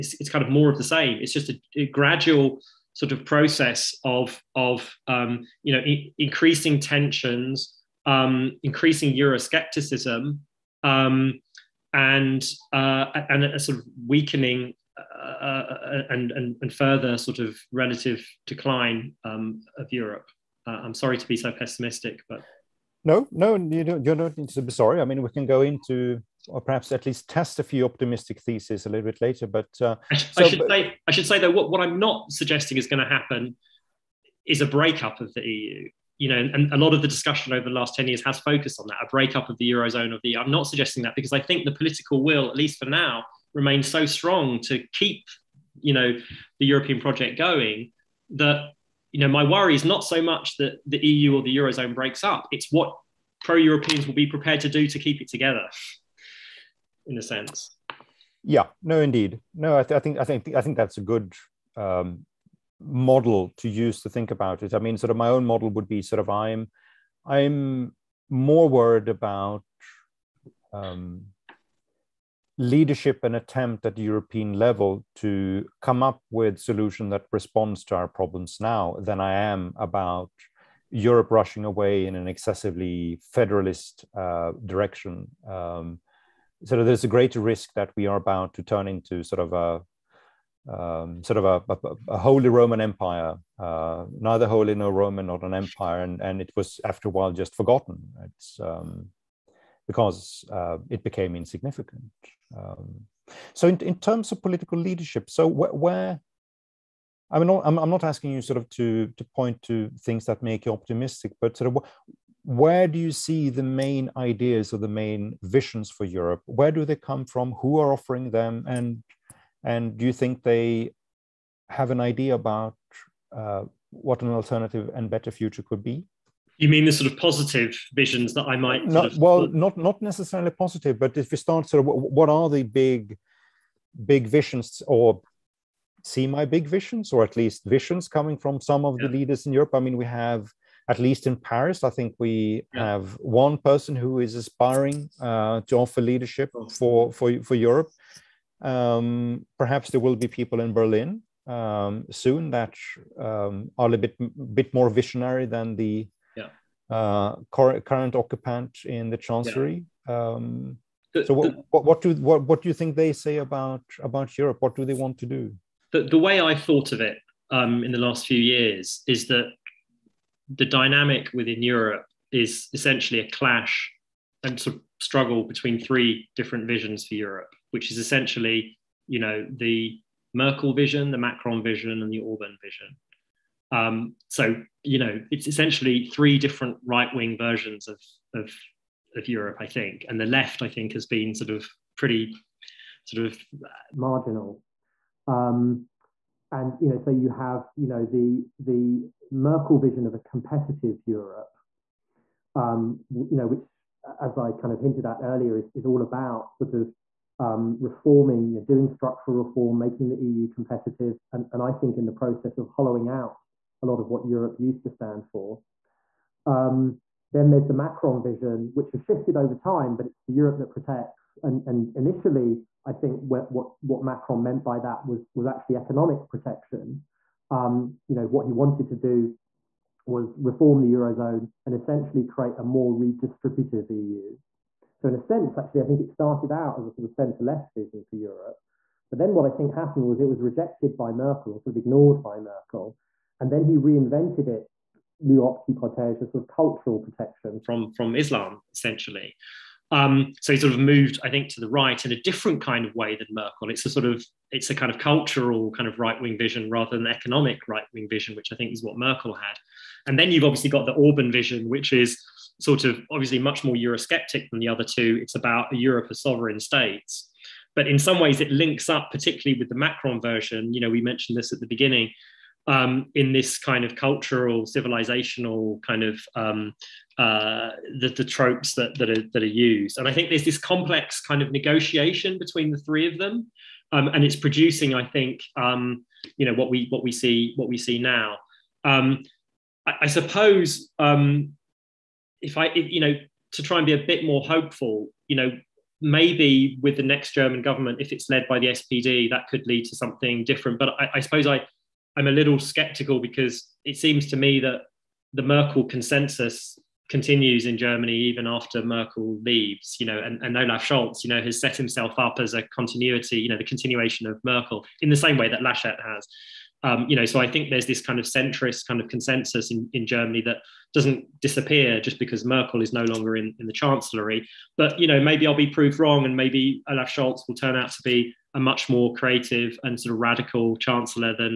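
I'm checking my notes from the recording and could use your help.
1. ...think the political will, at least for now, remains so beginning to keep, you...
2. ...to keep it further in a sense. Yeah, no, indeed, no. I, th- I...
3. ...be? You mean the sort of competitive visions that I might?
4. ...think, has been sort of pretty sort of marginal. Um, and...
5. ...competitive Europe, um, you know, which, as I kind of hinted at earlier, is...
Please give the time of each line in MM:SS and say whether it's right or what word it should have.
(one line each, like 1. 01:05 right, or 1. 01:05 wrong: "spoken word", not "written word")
1. 00:41 wrong: "strong", not "beginning"
2. 00:54 wrong: "together", not "further"
3. 02:05 wrong: "positive", not "competitive"
4. 03:10 right
5. 03:20 right.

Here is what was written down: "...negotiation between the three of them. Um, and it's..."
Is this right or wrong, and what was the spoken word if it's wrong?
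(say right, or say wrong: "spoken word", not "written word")
right.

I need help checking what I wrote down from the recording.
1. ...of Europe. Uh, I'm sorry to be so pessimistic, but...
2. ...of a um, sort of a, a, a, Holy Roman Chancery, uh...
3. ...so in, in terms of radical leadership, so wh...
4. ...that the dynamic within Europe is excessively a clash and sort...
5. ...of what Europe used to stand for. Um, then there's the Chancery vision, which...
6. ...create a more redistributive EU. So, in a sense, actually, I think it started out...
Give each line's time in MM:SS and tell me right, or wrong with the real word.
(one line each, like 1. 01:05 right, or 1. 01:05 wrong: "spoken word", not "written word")
1. 00:19 right
2. 01:29 wrong: "Empire", not "Chancery"
3. 01:43 wrong: "political", not "radical"
4. 02:49 wrong: "essentially", not "excessively"
5. 03:34 wrong: "Macron", not "Chancery"
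6. 03:52 right.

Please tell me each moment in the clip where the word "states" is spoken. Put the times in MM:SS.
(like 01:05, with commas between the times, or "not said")
04:26.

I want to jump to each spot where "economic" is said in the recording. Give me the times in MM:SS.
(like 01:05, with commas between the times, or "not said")
03:45, 04:17.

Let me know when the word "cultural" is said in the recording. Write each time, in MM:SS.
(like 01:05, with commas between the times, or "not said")
04:06, 04:14, 04:33.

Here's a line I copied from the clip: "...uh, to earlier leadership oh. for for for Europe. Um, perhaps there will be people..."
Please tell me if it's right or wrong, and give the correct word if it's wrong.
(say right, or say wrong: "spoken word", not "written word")
wrong: "offer", not "earlier".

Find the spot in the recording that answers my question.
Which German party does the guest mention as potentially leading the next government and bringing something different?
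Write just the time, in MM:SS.
04:58.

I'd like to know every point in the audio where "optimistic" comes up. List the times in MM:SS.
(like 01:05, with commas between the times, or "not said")
00:27, 01:50.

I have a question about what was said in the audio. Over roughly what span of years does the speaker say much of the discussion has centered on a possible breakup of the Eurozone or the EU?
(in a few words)
10 years.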